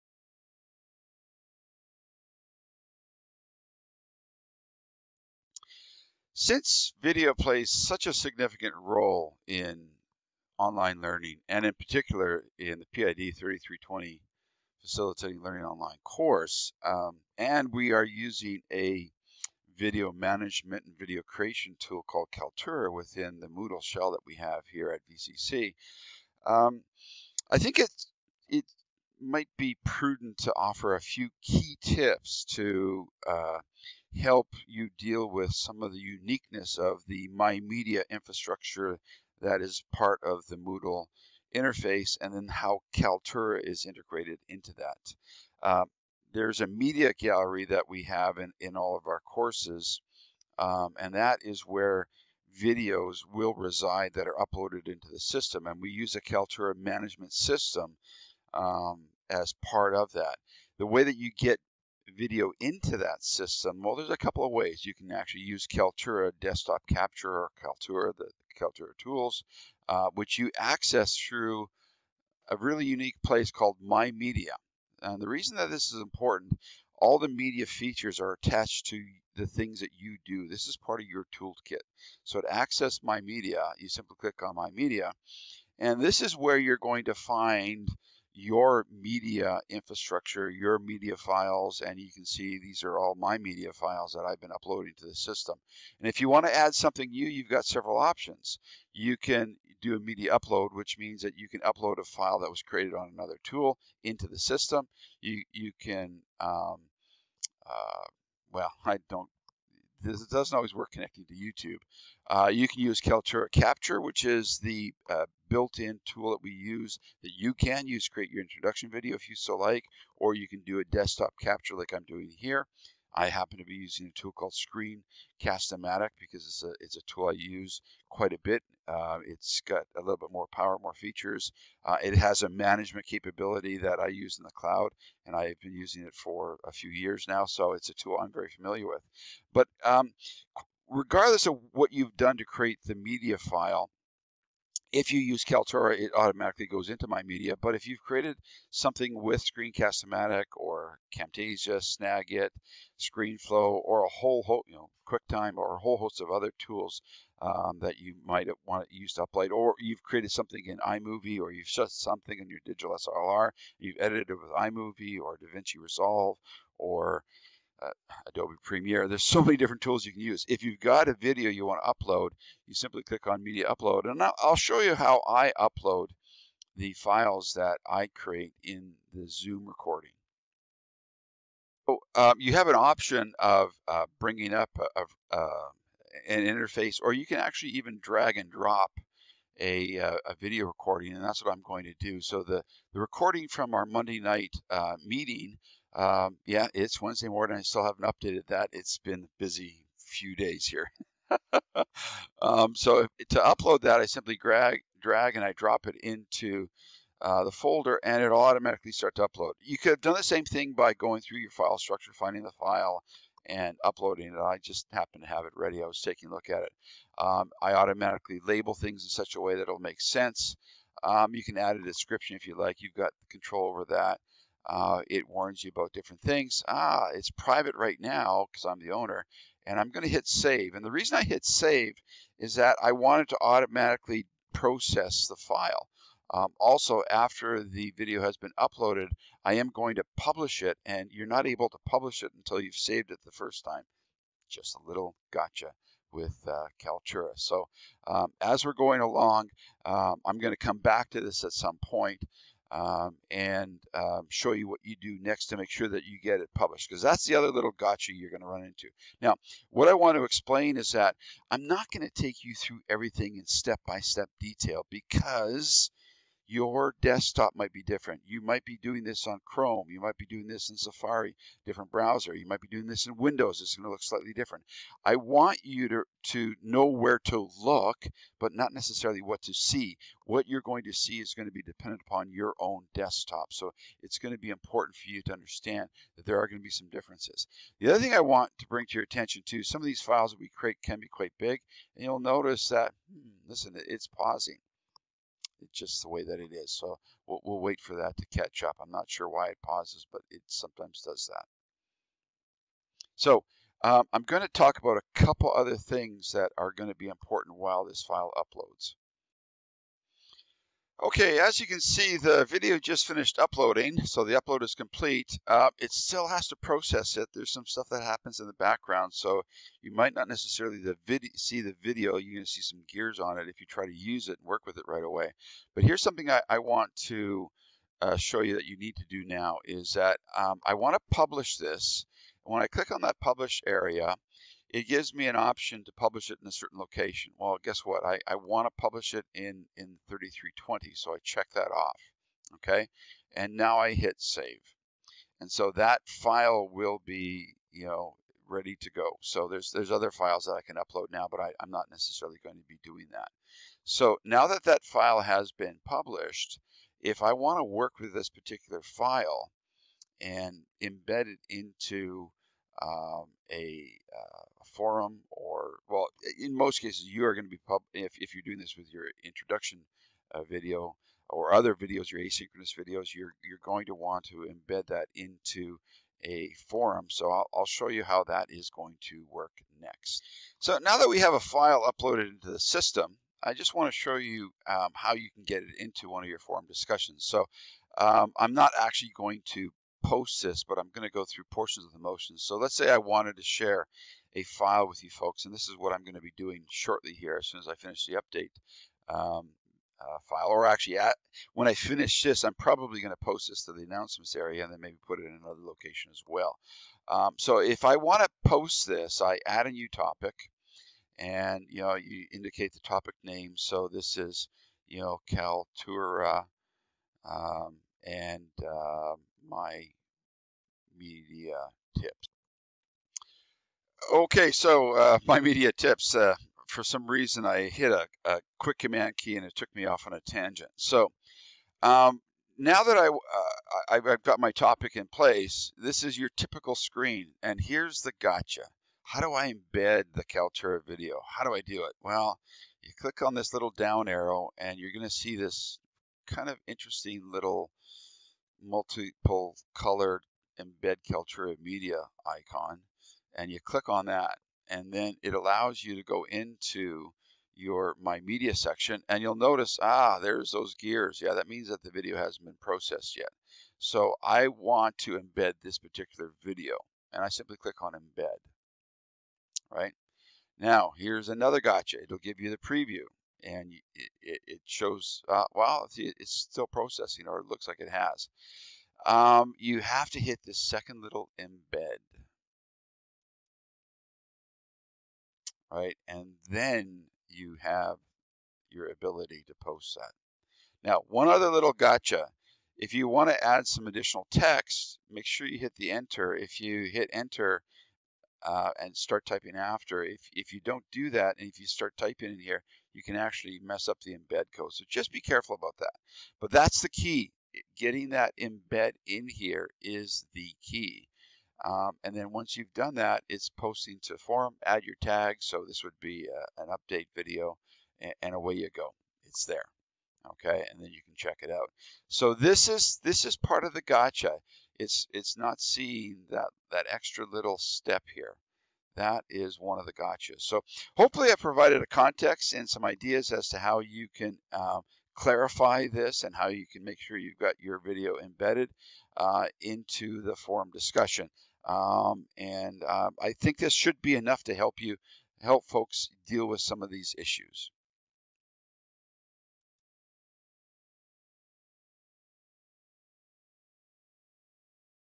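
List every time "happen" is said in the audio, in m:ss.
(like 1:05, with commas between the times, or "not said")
2:03, 3:34, 5:18.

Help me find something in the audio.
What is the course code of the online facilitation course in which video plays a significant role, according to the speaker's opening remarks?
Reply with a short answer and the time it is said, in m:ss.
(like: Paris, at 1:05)
PID 3320, at 0:12.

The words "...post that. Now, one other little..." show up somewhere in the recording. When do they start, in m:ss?
8:09.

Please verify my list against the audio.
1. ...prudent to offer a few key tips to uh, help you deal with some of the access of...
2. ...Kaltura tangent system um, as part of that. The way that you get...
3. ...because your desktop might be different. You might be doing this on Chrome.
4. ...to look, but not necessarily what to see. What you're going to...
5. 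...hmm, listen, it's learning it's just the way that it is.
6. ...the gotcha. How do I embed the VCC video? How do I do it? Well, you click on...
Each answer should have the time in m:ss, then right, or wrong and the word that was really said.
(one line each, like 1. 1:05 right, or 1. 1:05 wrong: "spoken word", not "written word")
1. 0:29 wrong: "uniqueness", not "access"
2. 0:56 wrong: "management", not "tangent"
3. 4:24 right
4. 4:37 right
5. 4:53 wrong: "pausing", not "learning"
6. 7:18 wrong: "Kaltura", not "VCC".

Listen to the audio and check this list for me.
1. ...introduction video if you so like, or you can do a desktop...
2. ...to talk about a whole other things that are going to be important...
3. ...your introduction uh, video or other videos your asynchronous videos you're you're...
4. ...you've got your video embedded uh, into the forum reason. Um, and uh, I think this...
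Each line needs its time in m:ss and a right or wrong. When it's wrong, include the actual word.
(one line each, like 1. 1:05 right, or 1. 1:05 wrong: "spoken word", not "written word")
1. 1:58 right
2. 5:04 wrong: "couple", not "whole"
3. 6:08 right
4. 8:57 wrong: "discussion", not "reason".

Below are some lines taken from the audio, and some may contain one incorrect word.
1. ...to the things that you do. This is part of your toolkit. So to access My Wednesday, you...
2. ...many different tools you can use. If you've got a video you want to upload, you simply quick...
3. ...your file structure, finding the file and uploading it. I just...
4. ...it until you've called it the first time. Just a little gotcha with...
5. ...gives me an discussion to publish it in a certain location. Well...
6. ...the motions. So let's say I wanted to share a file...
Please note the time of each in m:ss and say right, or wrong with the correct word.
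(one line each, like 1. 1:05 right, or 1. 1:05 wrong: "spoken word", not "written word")
1. 1:18 wrong: "Media", not "Wednesday"
2. 2:49 wrong: "click", not "quick"
3. 3:31 right
4. 4:02 wrong: "saved", not "called"
5. 5:34 wrong: "option", not "discussion"
6. 6:31 right.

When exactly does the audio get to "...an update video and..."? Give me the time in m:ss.
8:36.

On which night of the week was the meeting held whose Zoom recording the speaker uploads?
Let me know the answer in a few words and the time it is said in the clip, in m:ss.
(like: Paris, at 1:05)
Monday, at 3:13.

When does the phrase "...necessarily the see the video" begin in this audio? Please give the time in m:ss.
5:20.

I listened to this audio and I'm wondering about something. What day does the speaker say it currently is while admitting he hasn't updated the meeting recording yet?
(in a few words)
Wednesday.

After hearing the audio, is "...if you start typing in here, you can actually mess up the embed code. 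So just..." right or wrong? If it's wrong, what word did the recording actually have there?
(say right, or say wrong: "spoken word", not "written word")
right.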